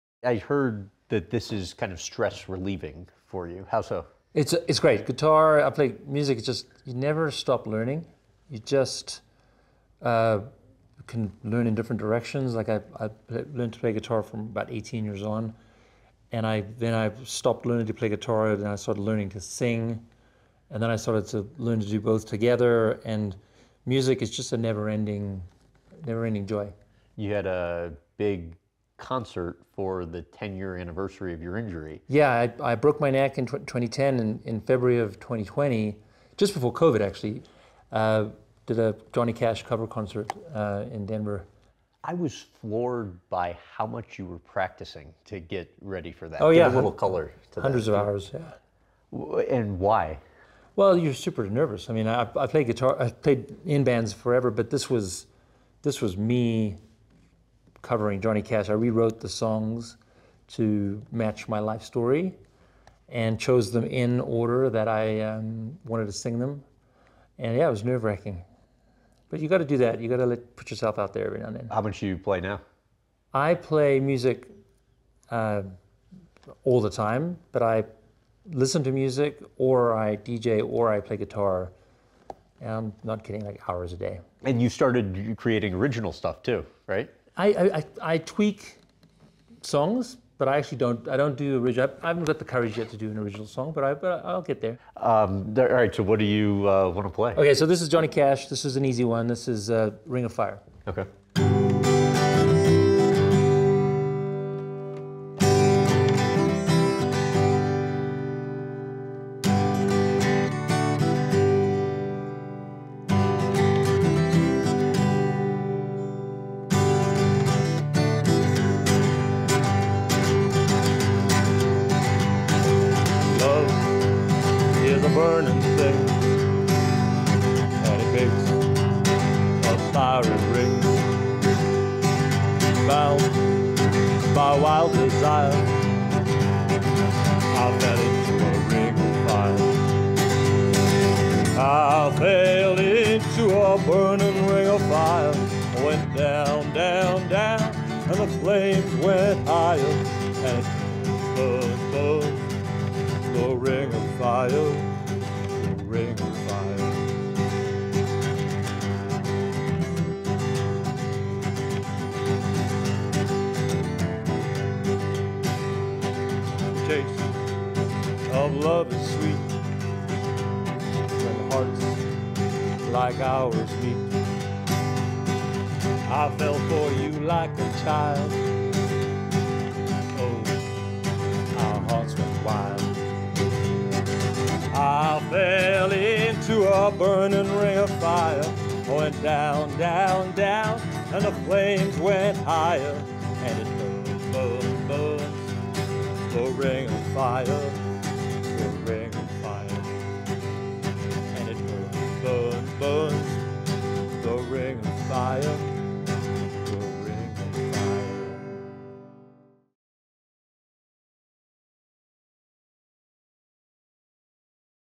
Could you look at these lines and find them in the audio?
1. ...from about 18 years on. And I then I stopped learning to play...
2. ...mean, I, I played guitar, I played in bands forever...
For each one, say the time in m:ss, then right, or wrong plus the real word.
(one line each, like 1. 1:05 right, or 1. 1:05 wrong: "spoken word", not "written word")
1. 0:14 right
2. 0:51 right.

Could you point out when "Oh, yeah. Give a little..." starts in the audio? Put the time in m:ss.
0:46.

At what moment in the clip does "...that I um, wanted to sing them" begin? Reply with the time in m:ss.
1:04.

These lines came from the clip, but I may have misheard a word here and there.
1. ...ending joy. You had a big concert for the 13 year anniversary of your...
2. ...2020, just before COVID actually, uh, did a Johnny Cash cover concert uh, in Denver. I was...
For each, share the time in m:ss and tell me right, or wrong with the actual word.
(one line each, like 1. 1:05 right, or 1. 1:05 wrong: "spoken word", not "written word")
1. 0:26 wrong: "10", not "13"
2. 0:35 right.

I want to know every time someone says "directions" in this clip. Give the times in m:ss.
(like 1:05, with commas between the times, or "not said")
0:11.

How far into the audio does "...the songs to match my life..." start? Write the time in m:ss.
0:59.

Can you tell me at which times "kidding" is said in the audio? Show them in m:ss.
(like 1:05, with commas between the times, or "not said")
1:23.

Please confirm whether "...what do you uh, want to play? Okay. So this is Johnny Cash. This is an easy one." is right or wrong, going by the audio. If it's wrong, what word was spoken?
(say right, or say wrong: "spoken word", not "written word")
right.